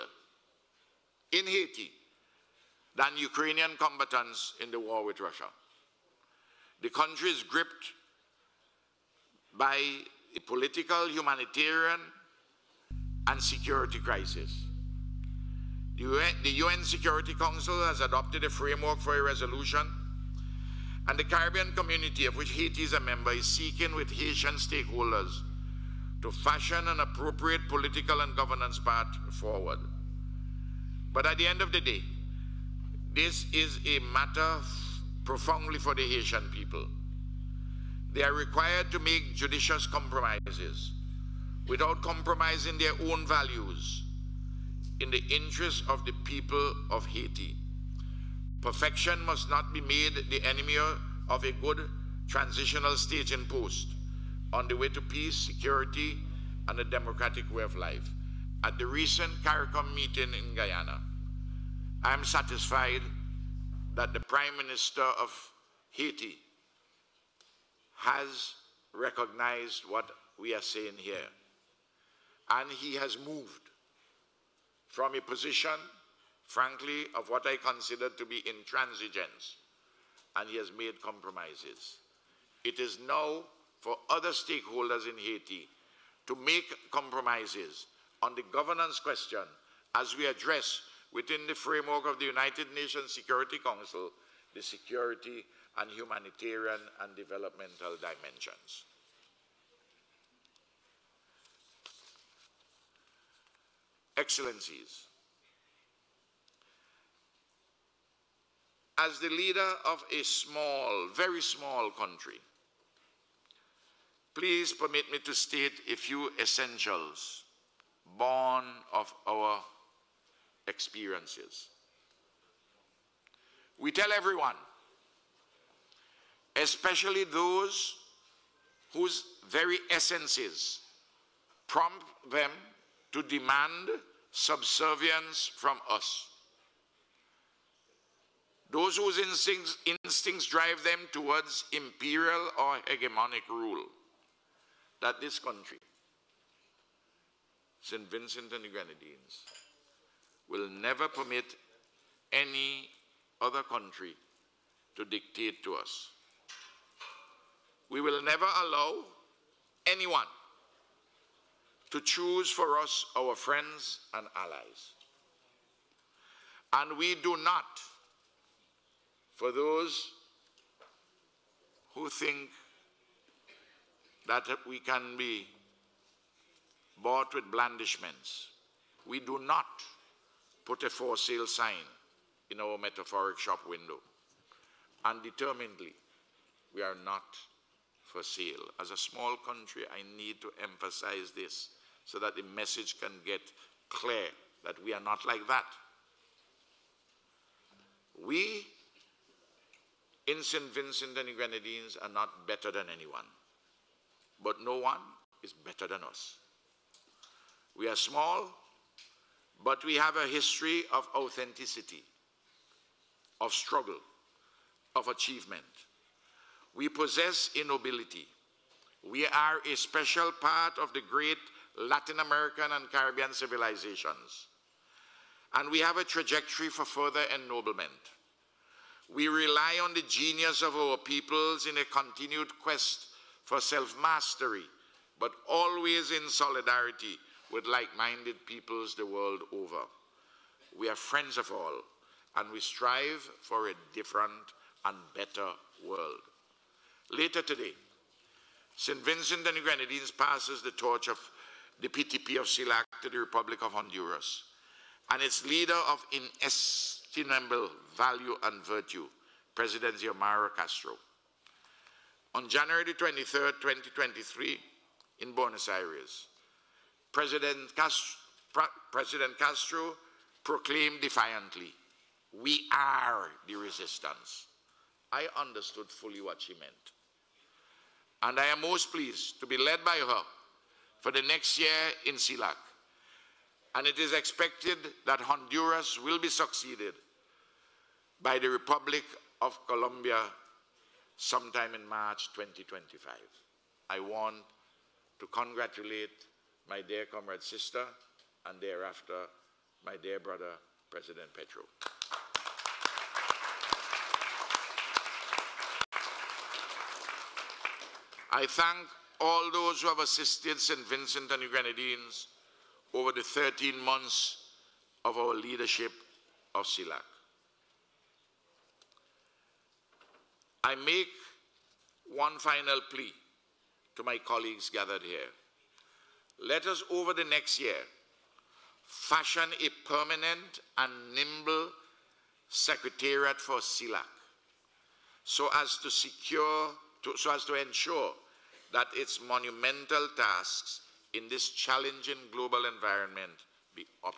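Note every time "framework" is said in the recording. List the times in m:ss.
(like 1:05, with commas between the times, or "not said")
0:18, 1:31.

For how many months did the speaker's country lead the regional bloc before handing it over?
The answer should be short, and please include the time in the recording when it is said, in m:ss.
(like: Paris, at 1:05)
13, at 5:13.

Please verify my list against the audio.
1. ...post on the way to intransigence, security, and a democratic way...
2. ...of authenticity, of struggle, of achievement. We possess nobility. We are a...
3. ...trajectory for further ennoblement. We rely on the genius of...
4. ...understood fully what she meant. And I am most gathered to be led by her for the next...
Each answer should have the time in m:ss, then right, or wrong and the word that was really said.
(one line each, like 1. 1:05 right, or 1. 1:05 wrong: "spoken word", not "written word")
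1. 0:53 wrong: "peace", not "intransigence"
2. 3:30 right
3. 3:46 right
4. 4:35 wrong: "pleased", not "gathered".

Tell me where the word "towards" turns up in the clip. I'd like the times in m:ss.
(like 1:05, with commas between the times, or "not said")
2:21.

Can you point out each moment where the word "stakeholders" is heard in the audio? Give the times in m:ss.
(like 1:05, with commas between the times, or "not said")
0:24, 1:24.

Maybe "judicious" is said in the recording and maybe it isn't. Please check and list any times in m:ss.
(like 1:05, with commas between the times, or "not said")
0:39.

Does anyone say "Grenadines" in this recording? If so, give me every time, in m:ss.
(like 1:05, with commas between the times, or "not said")
2:28, 3:21, 4:09, 5:11.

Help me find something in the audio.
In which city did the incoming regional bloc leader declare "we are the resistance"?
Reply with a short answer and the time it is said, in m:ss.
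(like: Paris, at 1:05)
Buenos Aires, at 4:25.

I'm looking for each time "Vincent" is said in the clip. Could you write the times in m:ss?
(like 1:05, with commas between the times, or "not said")
2:28, 3:20, 4:09, 5:10.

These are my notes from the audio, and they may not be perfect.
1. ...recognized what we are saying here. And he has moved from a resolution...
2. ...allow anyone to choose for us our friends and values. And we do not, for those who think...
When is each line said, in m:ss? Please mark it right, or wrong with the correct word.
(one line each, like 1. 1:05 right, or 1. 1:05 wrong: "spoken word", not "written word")
1. 1:08 wrong: "position", not "resolution"
2. 2:38 wrong: "allies", not "values".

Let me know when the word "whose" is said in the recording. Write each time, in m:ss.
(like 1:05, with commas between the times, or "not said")
2:08, 2:18.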